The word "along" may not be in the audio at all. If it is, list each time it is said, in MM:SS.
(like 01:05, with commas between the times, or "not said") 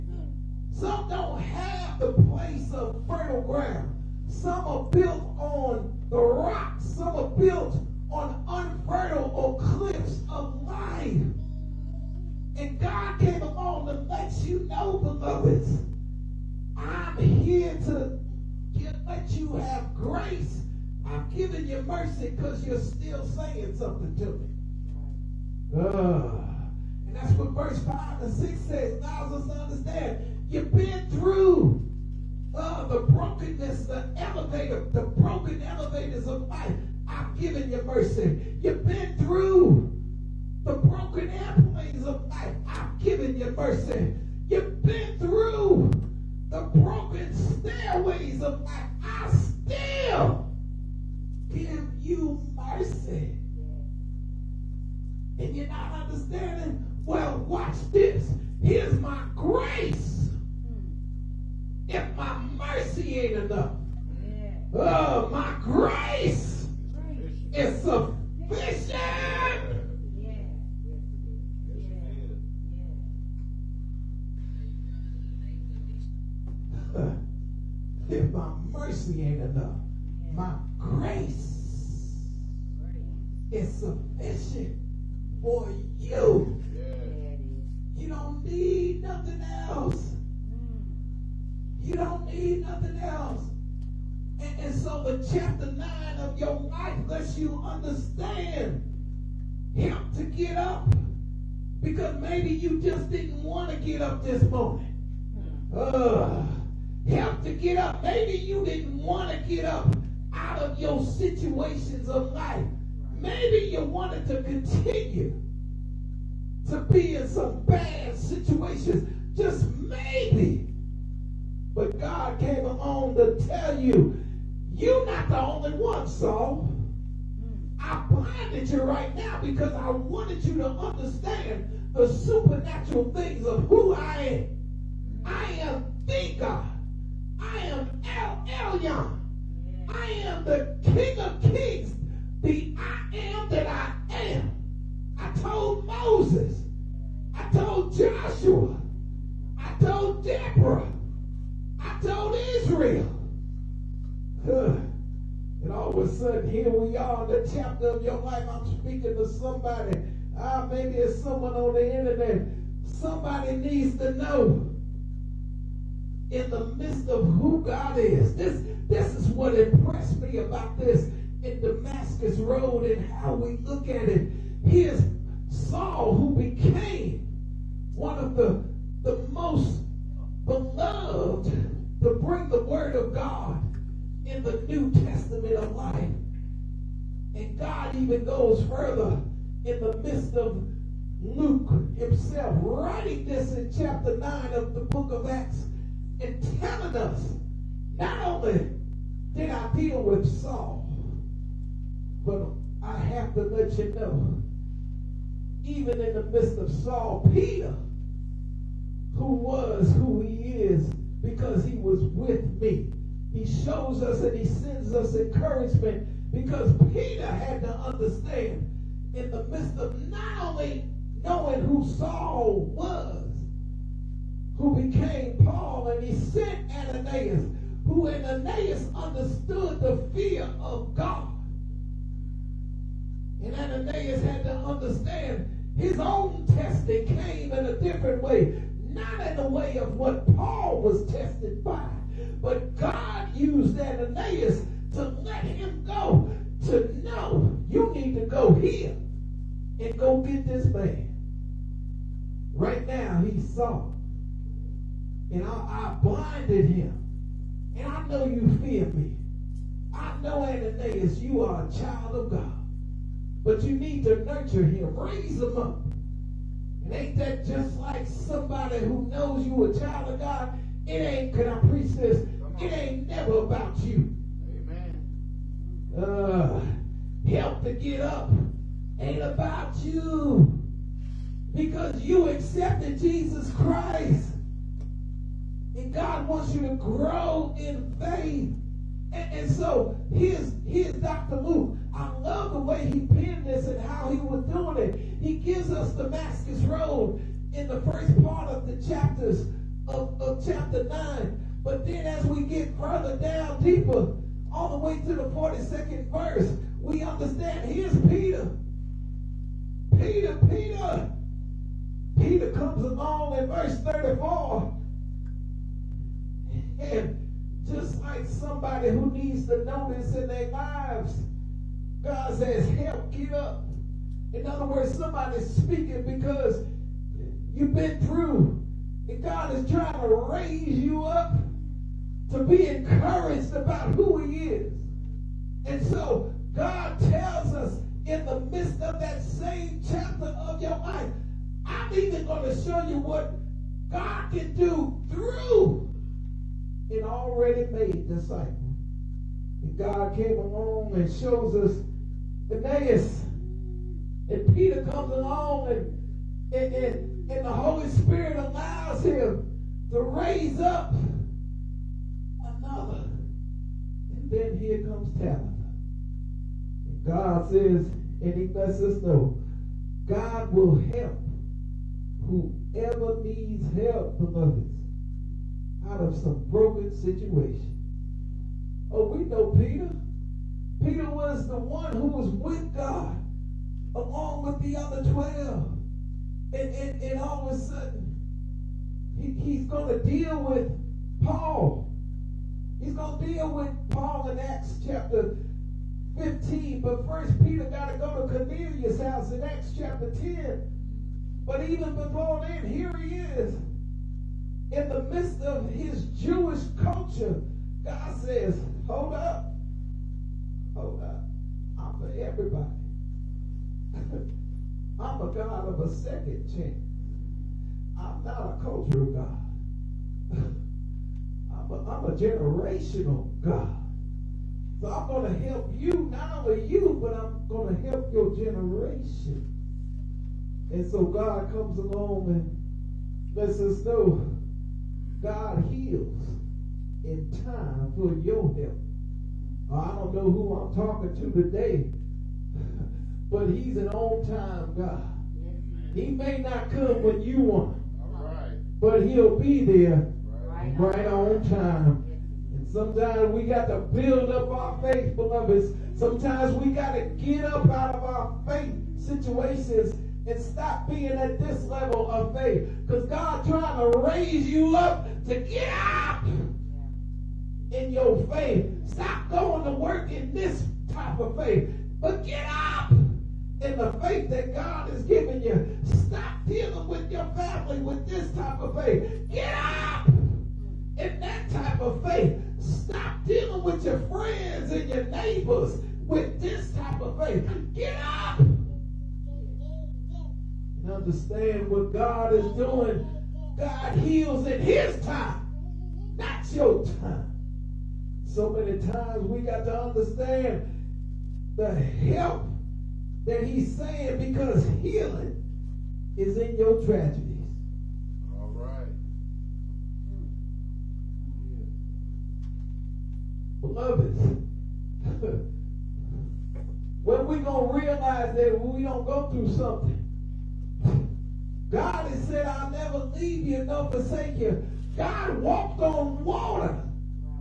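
02:02, 06:23, 07:11.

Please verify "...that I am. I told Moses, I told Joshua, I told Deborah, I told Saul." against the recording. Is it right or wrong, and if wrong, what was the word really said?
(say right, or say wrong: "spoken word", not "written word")
wrong: "Israel", not "Saul".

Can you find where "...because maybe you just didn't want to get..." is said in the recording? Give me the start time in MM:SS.
01:41.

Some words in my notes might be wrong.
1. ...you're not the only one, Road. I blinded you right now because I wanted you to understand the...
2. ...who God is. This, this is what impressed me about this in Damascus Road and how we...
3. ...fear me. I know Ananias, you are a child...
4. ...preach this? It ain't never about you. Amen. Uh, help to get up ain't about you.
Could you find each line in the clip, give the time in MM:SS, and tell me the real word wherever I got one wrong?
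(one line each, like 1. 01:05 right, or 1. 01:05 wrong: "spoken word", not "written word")
1. 02:04 wrong: "Saul", not "Road"
2. 02:47 right
3. 04:18 right
4. 04:31 right.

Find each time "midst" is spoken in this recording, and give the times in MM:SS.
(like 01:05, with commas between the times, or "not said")
02:46, 03:10, 03:26, 03:39, 06:45.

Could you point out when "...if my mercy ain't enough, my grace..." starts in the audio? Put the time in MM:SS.
01:18.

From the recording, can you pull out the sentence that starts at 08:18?
So many times we got to understand the help that he's saying because healing is in your tragedy.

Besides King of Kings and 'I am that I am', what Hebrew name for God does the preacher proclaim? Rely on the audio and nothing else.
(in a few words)
El Elyon.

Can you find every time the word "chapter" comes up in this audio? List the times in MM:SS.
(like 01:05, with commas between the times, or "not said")
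01:35, 02:37, 03:13, 06:34, 06:39.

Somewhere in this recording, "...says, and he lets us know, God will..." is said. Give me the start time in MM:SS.
06:07.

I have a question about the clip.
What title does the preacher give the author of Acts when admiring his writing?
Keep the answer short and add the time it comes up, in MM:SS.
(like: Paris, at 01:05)
Dr. Luke, at 04:50.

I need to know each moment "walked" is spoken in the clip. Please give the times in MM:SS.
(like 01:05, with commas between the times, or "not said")
08:45.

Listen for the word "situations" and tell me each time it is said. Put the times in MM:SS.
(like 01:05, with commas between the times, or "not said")
01:51, 01:58, 06:16, 07:38.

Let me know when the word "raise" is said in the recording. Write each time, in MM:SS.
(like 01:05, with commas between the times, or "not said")
04:24, 07:43.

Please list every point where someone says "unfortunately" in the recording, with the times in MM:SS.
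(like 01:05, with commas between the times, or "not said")
not said.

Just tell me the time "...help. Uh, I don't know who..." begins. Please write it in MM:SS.
07:18.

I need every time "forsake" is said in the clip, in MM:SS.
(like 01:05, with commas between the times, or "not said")
08:43.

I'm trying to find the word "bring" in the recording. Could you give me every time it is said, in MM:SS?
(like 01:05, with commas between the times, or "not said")
03:02.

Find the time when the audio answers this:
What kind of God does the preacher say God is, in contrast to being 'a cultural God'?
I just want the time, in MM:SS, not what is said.
07:02.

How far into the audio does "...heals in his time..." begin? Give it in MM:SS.
08:13.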